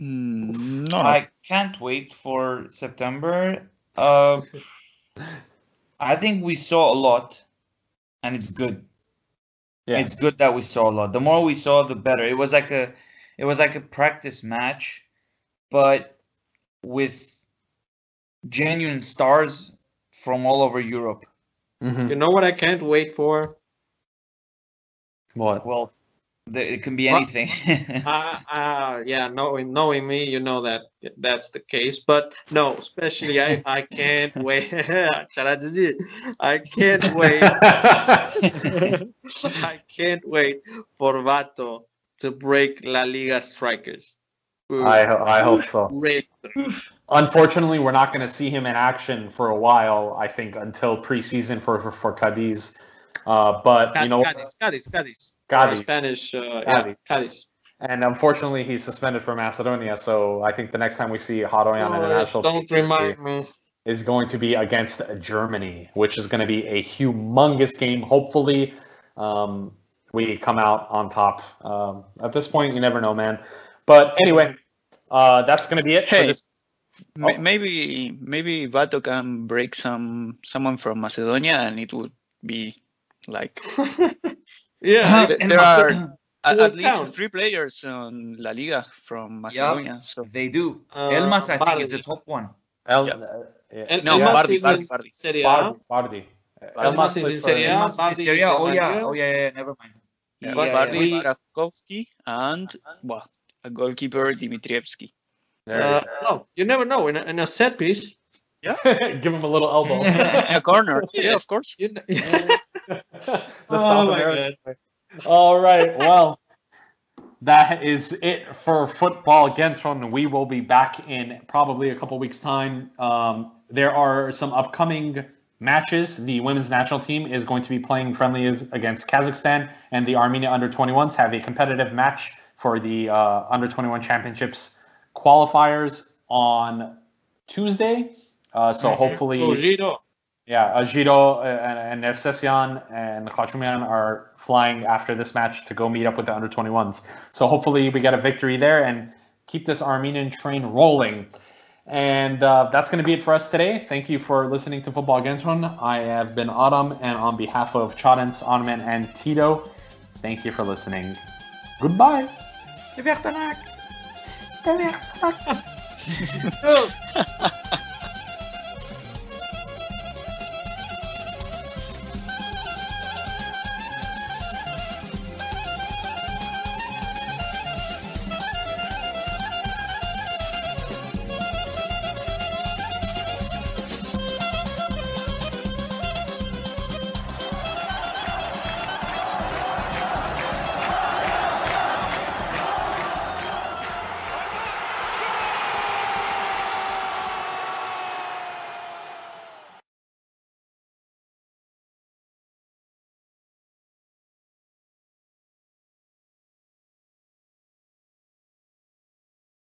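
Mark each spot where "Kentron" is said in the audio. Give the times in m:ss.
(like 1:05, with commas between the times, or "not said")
1:59, 2:35.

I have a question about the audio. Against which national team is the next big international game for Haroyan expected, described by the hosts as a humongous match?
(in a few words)
Germany.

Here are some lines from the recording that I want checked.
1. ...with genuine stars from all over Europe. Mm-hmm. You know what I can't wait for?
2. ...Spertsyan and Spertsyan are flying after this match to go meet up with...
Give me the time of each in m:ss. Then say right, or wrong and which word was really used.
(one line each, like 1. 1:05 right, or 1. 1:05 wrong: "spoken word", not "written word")
1. 0:16 right
2. 2:22 wrong: "Khachumyan", not "Spertsyan".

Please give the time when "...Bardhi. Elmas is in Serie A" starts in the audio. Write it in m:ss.
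1:35.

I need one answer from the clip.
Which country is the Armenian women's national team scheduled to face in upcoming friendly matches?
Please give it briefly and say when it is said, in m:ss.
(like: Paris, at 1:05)
Kazakhstan, at 2:09.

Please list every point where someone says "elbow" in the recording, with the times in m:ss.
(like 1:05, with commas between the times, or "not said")
1:49.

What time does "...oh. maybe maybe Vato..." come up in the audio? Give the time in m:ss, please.
1:17.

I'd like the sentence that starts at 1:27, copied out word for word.
three players on La Liga from Macedonia.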